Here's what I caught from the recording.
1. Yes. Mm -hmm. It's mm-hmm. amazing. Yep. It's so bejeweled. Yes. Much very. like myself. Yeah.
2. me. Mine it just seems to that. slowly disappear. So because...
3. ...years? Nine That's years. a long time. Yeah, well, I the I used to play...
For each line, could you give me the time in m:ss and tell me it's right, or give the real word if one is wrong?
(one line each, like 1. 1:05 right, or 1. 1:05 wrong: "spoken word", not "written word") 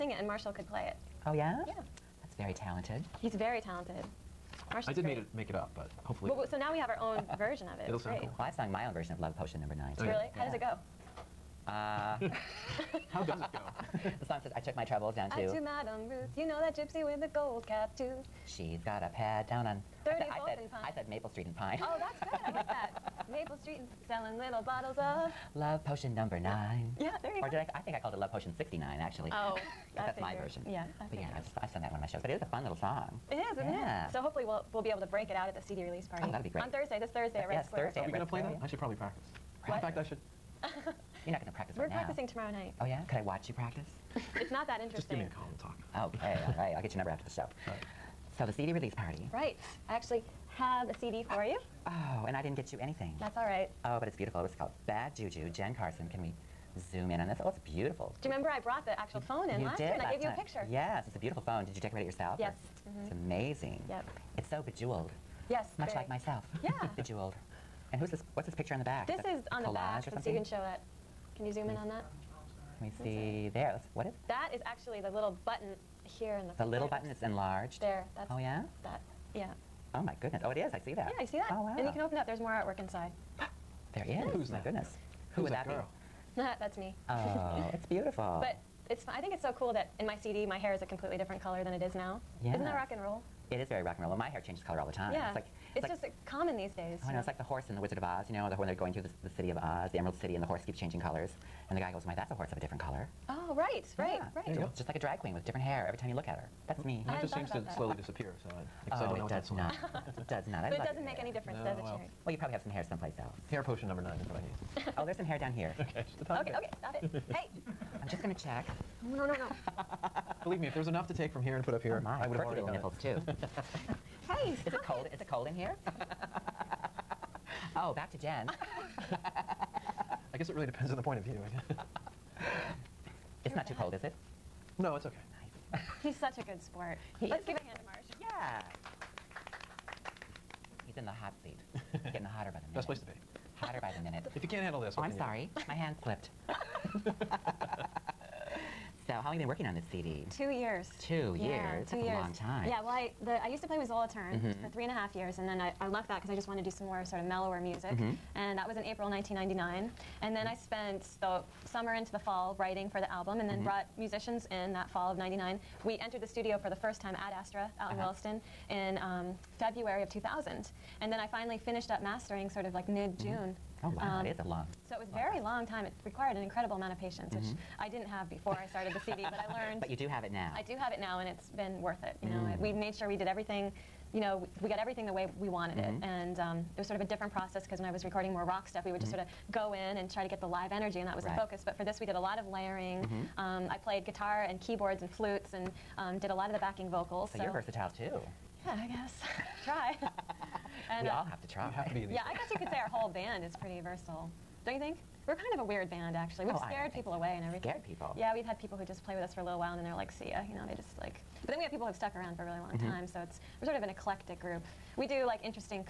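1. 1:02 right
2. 1:46 right
3. 2:31 wrong: "Two", not "Nine".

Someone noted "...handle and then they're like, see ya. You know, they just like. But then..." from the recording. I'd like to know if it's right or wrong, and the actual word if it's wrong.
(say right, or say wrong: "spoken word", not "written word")
wrong: "while", not "handle".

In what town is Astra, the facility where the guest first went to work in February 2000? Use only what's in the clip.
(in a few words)
Williston.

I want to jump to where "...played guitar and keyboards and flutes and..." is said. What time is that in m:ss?
3:13.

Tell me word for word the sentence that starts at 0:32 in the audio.
But it is a fun little song.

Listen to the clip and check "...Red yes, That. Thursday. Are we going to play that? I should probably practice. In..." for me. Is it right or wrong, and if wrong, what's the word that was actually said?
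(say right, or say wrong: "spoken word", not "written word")
wrong: "Square", not "That".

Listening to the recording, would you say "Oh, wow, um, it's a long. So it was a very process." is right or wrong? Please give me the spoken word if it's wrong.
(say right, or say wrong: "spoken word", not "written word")
right.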